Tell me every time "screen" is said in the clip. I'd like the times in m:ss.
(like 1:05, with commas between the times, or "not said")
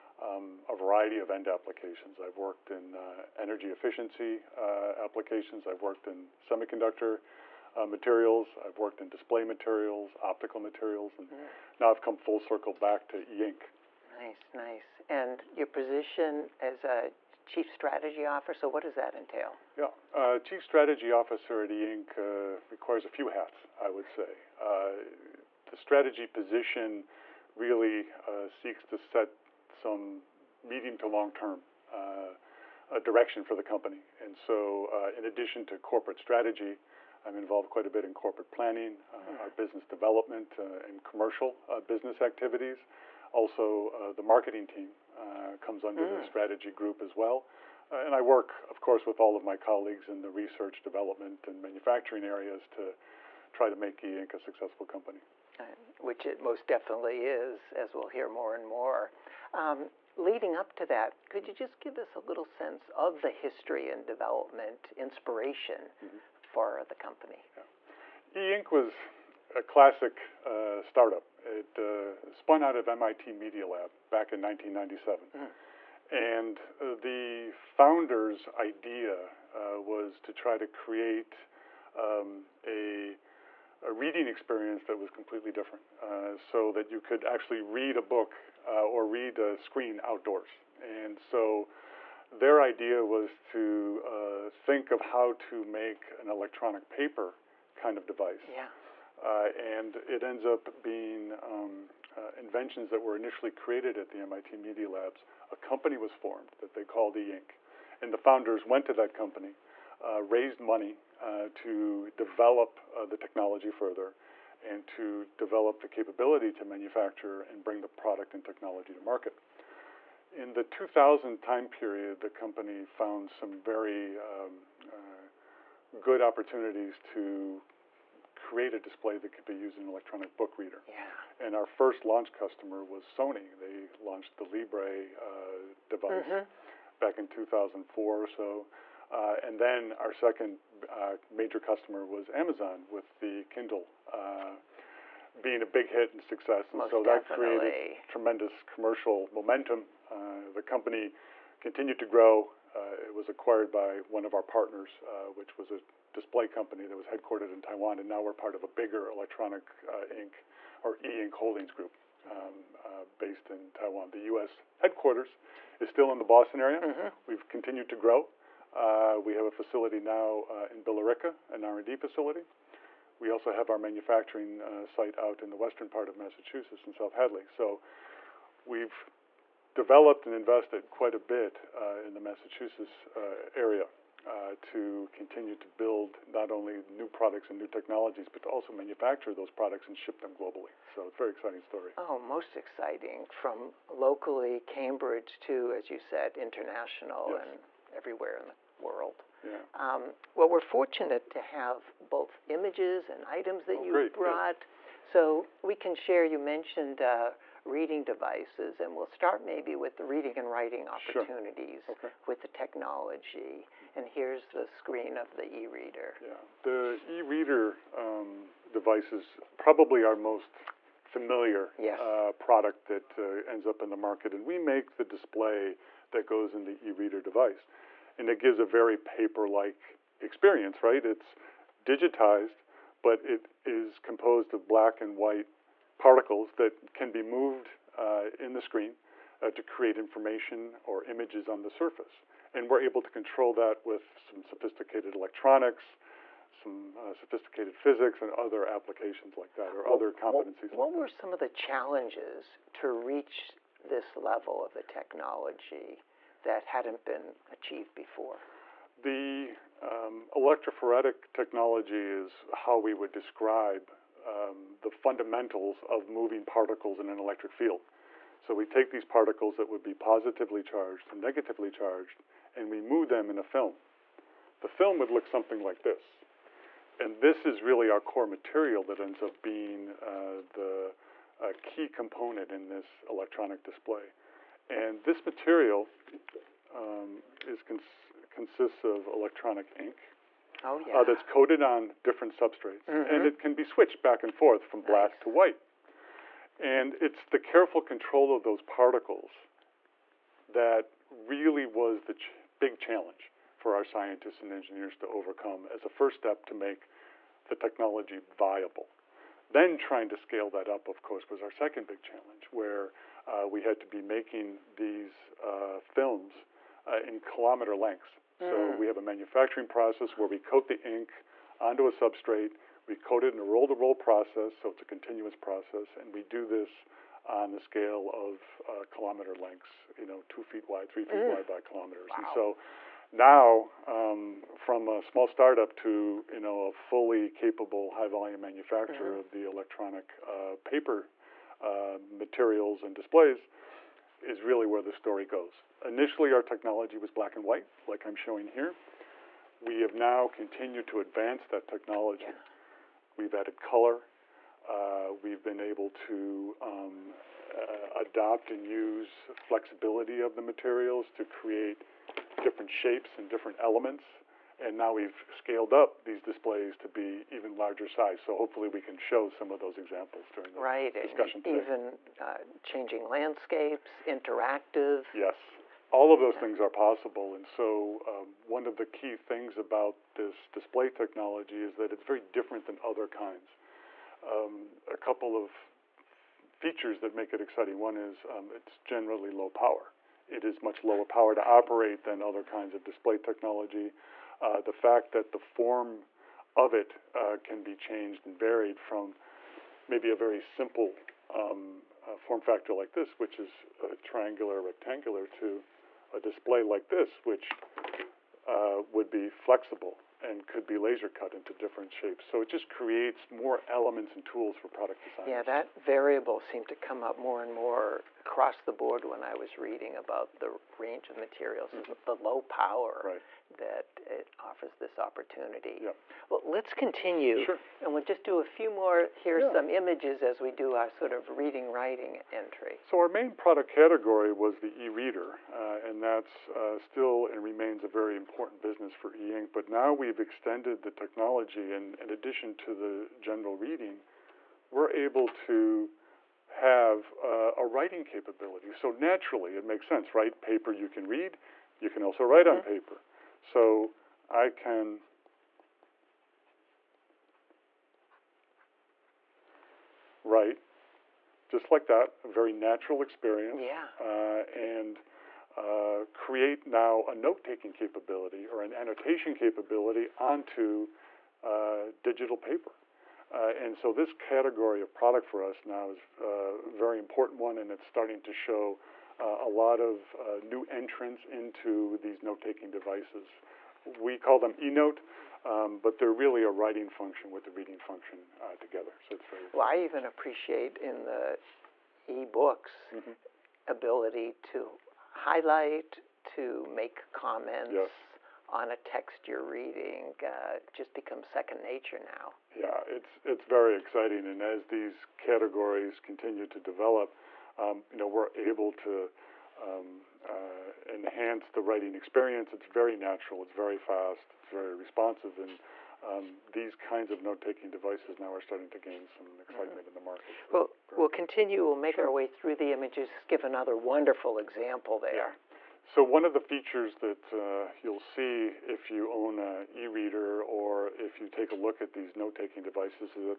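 1:29, 3:34, 3:58.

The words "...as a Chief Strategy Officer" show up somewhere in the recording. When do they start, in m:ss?
0:16.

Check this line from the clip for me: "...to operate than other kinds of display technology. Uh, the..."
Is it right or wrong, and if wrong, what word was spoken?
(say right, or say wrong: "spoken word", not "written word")
right.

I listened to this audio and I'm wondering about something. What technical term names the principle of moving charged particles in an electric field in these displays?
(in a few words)
electrophoretic.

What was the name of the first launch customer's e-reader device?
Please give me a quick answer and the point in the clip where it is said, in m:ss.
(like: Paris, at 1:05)
Librie, at 2:14.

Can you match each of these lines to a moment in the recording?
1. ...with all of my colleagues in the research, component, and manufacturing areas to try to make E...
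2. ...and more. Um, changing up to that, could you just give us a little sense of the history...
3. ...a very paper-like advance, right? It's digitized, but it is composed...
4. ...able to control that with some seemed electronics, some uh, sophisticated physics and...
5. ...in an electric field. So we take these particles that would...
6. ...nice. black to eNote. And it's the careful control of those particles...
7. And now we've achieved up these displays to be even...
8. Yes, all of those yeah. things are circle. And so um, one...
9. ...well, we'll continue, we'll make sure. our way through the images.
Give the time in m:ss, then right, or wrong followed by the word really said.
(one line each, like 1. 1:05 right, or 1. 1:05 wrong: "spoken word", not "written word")
1. 0:49 wrong: "development", not "component"
2. 0:58 wrong: "leading", not "changing"
3. 3:48 wrong: "experience", not "advance"
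4. 4:02 wrong: "sophisticated", not "seemed"
5. 4:26 right
6. 4:54 wrong: "white", not "eNote"
7. 6:04 wrong: "scaled", not "achieved"
8. 6:15 wrong: "possible", not "circle"
9. 8:40 right.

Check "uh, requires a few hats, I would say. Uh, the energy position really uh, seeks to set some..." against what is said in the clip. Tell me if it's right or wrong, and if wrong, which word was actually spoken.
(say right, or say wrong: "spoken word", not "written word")
wrong: "strategy", not "energy".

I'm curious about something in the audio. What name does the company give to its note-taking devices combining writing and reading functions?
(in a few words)
eNote.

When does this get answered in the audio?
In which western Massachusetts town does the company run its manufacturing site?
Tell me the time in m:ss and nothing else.
2:56.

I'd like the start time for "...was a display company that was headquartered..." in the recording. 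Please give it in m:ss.
2:35.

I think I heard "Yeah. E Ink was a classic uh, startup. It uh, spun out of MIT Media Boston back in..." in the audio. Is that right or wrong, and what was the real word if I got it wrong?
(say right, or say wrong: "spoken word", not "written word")
wrong: "Lab", not "Boston".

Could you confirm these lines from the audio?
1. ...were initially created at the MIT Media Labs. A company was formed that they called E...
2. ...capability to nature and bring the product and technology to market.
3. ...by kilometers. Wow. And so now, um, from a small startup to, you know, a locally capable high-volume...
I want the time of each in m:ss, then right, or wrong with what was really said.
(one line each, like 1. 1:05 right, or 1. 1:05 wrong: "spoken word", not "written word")
1. 1:42 right
2. 1:55 wrong: "manufacture", not "nature"
3. 5:31 wrong: "fully", not "locally".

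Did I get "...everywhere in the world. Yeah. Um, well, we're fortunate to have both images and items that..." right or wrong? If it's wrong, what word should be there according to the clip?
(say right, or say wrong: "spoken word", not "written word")
right.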